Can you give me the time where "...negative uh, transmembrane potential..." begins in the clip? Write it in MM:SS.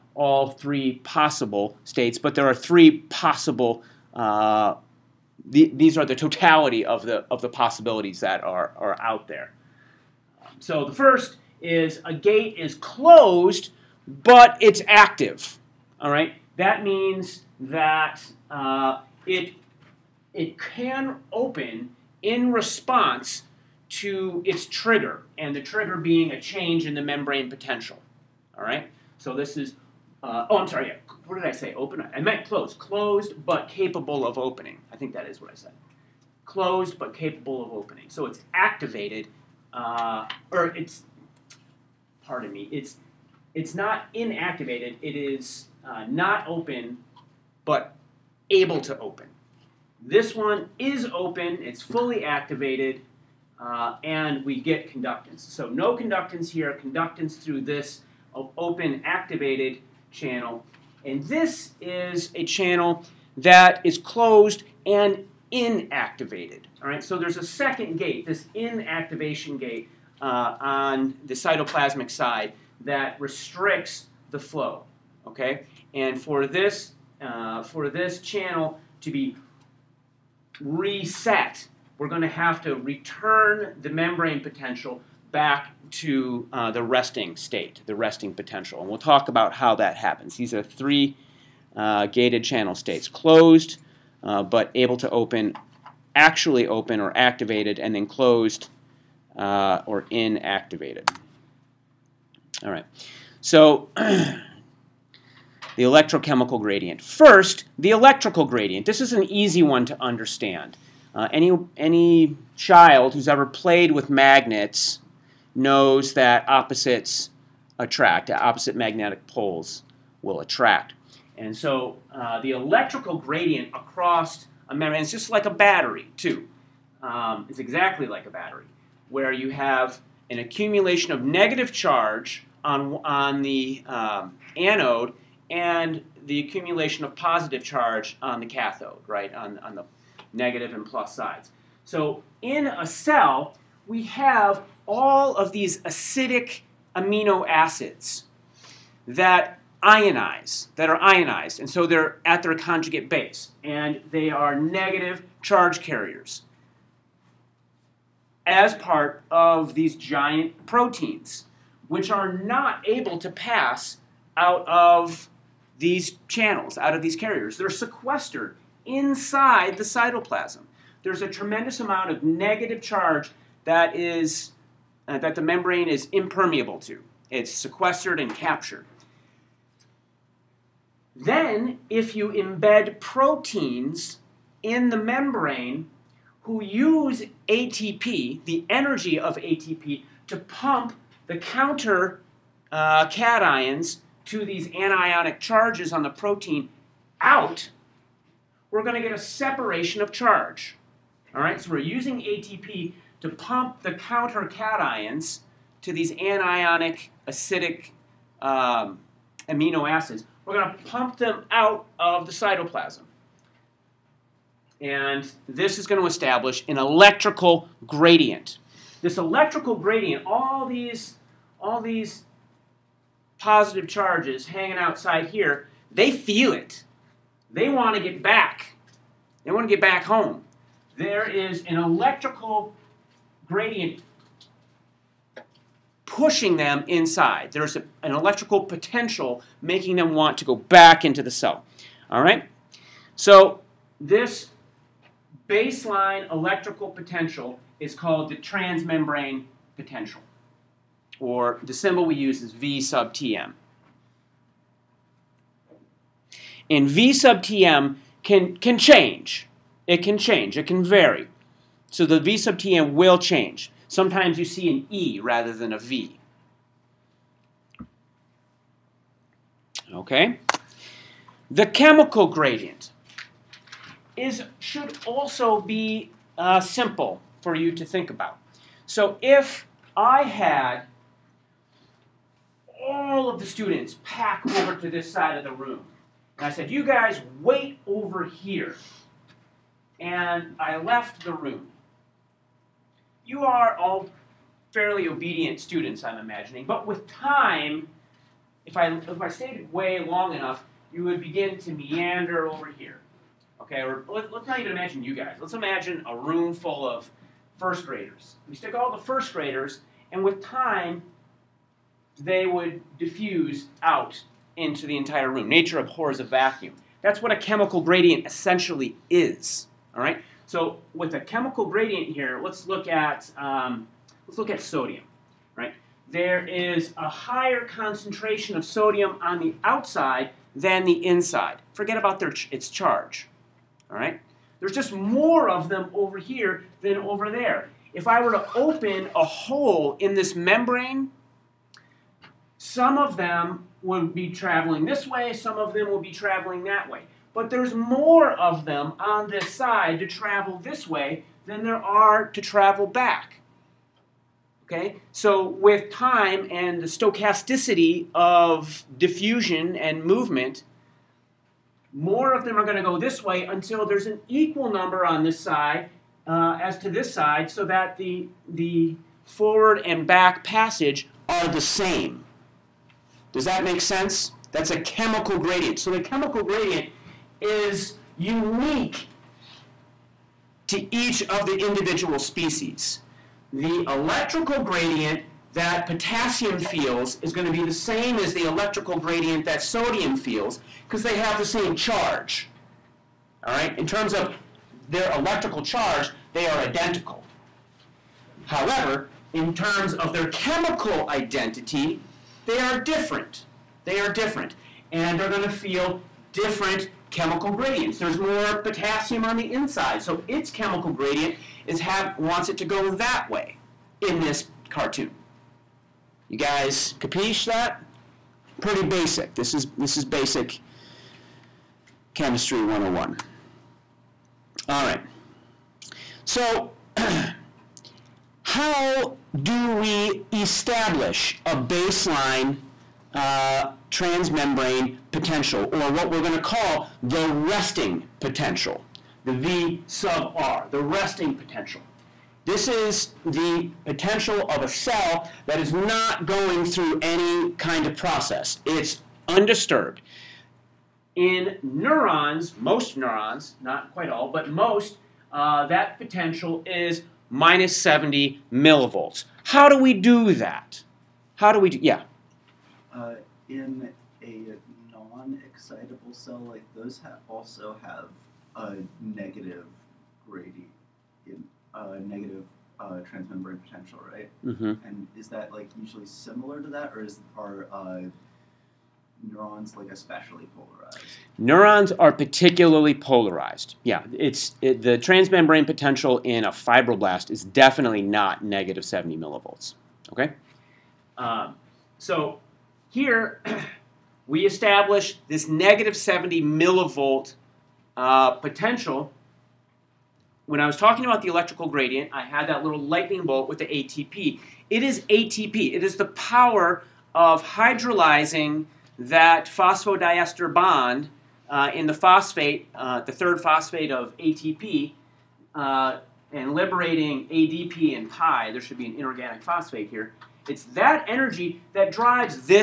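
07:52.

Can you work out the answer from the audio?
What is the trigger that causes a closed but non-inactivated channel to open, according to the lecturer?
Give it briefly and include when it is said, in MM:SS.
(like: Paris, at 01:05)
change in the membrane potential, at 00:26.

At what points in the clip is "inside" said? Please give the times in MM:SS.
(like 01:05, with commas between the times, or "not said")
02:48, 03:56, 05:31, 06:49.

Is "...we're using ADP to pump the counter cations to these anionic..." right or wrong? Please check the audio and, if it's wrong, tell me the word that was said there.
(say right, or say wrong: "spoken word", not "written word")
wrong: "ATP", not "ADP".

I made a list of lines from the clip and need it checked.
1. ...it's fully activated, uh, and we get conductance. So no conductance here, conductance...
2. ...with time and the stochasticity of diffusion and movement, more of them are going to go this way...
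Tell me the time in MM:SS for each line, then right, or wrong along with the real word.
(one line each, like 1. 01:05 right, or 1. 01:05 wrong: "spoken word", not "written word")
1. 00:51 right
2. 05:55 right.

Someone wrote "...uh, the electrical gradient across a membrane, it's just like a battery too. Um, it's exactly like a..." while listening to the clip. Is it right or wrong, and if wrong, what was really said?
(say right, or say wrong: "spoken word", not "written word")
right.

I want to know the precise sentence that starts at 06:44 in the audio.
And they're going to feel different chemical gradients.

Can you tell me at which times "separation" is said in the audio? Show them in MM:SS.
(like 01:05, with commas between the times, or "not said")
03:19.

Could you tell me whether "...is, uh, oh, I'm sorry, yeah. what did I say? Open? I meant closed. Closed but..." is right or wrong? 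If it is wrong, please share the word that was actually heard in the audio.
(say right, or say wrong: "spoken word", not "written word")
right.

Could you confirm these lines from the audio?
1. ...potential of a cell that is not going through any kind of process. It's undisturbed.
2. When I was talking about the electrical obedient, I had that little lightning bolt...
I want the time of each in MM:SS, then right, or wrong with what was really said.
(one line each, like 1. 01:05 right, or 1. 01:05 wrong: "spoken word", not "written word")
1. 07:23 right
2. 08:20 wrong: "gradient", not "obedient".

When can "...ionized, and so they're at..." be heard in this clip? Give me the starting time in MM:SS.
02:30.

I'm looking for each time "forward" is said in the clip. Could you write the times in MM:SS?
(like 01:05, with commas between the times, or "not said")
06:09.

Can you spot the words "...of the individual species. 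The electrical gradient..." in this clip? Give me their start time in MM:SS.
06:21.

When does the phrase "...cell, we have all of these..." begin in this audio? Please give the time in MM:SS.
02:22.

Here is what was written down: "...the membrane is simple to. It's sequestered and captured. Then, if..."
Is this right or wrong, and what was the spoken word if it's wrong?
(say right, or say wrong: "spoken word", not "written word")
wrong: "impermeable", not "simple".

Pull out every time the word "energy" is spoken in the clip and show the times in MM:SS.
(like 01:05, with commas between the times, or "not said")
03:08, 08:41.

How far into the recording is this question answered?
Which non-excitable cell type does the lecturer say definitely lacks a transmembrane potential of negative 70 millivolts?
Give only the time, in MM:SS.
08:06.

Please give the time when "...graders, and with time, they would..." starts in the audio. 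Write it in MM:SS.
05:09.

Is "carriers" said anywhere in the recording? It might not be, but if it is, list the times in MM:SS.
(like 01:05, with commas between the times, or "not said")
02:35, 02:47.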